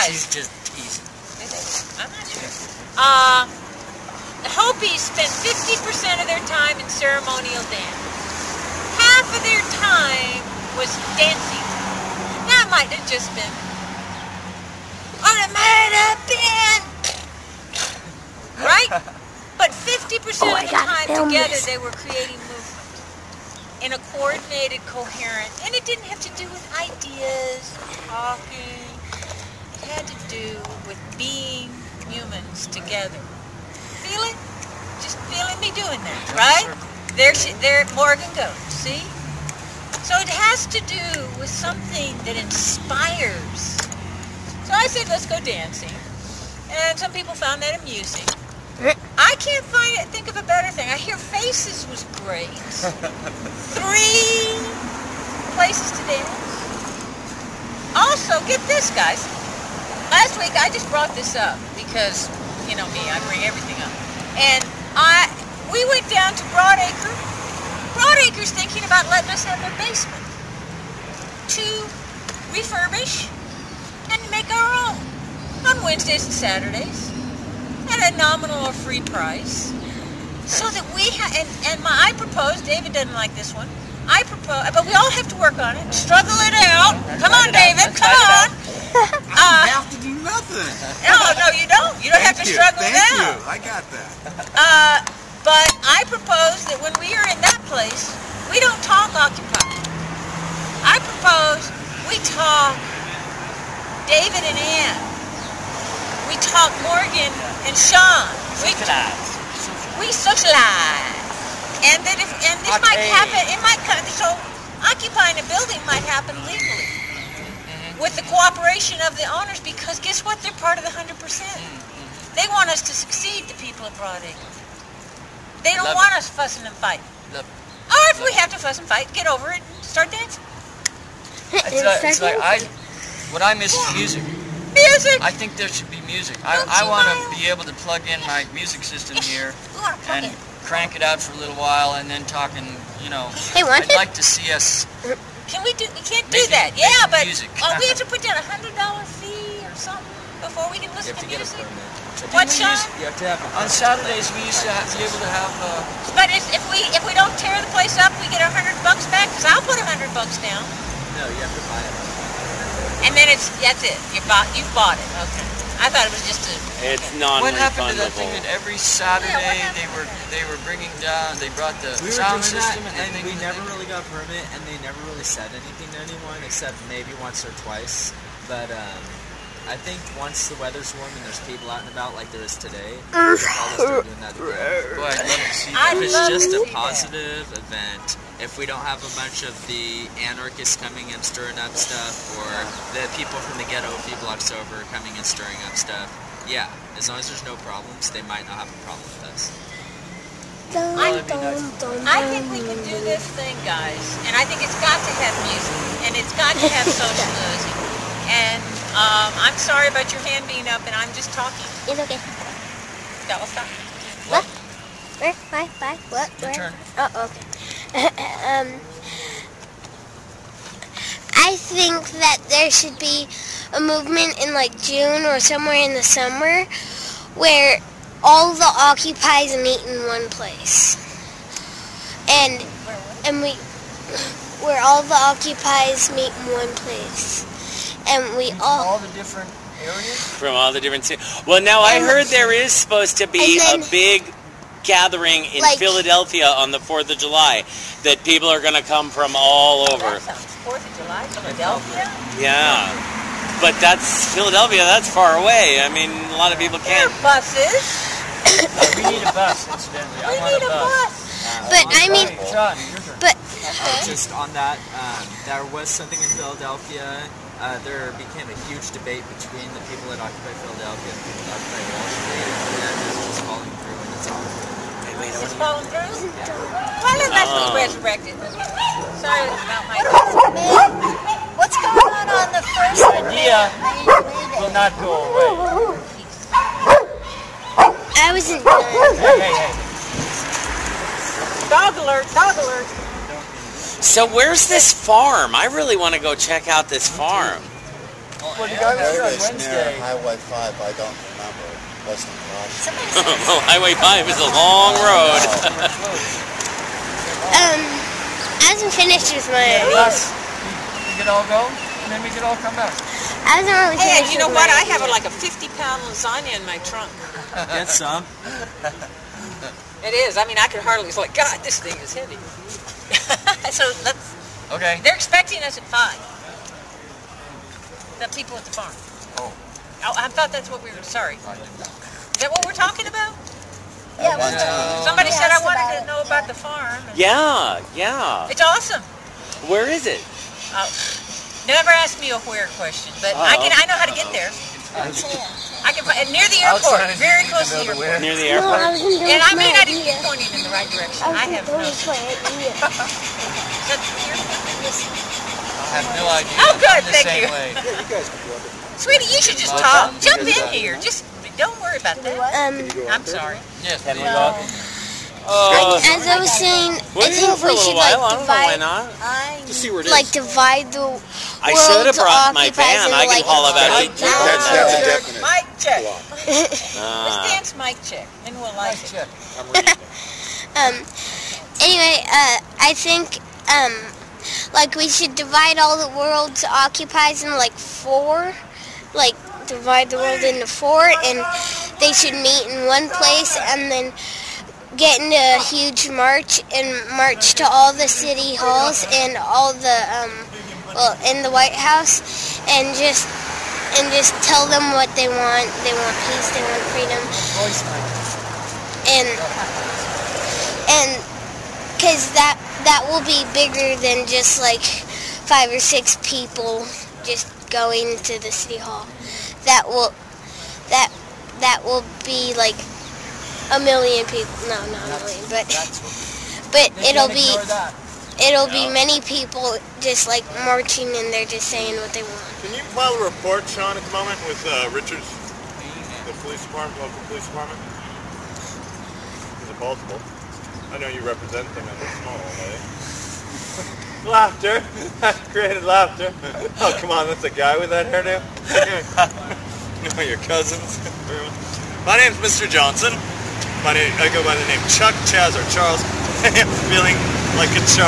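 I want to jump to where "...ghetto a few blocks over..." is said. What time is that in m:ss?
3:13.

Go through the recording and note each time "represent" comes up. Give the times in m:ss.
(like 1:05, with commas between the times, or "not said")
7:21.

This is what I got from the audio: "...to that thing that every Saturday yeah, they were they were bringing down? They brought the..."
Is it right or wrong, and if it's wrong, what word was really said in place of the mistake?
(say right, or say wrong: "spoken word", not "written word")
right.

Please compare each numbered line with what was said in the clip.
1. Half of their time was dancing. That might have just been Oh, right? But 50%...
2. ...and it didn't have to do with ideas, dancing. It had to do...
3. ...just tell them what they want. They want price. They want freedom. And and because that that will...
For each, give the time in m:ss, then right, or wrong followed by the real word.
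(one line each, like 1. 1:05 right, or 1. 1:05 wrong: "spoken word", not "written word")
1. 0:08 right
2. 0:25 wrong: "talking", not "dancing"
3. 6:44 wrong: "peace", not "price".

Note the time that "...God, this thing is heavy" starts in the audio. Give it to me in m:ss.
5:21.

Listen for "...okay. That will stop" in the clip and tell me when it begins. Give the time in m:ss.
3:31.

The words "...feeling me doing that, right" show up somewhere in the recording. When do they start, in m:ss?
0:35.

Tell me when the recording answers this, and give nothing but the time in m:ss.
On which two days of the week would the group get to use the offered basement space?
1:15.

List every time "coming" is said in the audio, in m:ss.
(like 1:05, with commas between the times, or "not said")
3:10, 3:14.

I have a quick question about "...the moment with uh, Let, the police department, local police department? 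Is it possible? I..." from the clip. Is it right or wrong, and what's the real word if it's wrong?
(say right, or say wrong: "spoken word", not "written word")
wrong: "Richards", not "Let".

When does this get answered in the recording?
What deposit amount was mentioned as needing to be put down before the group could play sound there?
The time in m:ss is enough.
2:28.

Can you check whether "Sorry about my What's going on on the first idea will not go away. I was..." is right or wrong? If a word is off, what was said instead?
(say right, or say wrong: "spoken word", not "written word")
right.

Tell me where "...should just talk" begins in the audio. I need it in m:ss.
5:59.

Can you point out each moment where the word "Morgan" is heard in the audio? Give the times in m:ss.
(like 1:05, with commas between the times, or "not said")
0:37, 1:46.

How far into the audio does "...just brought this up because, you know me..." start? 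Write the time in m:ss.
1:00.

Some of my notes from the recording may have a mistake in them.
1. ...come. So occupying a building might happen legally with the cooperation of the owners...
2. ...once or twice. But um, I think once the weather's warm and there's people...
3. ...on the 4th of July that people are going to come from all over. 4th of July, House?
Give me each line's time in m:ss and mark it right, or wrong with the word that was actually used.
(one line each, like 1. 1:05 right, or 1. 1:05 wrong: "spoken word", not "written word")
1. 1:53 right
2. 2:57 right
3. 4:06 wrong: "Philadelphia", not "House".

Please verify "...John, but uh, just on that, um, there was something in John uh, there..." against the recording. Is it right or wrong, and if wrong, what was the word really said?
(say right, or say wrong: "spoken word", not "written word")
wrong: "Philadelphia", not "John".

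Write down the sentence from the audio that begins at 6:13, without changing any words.
I can like, about it people.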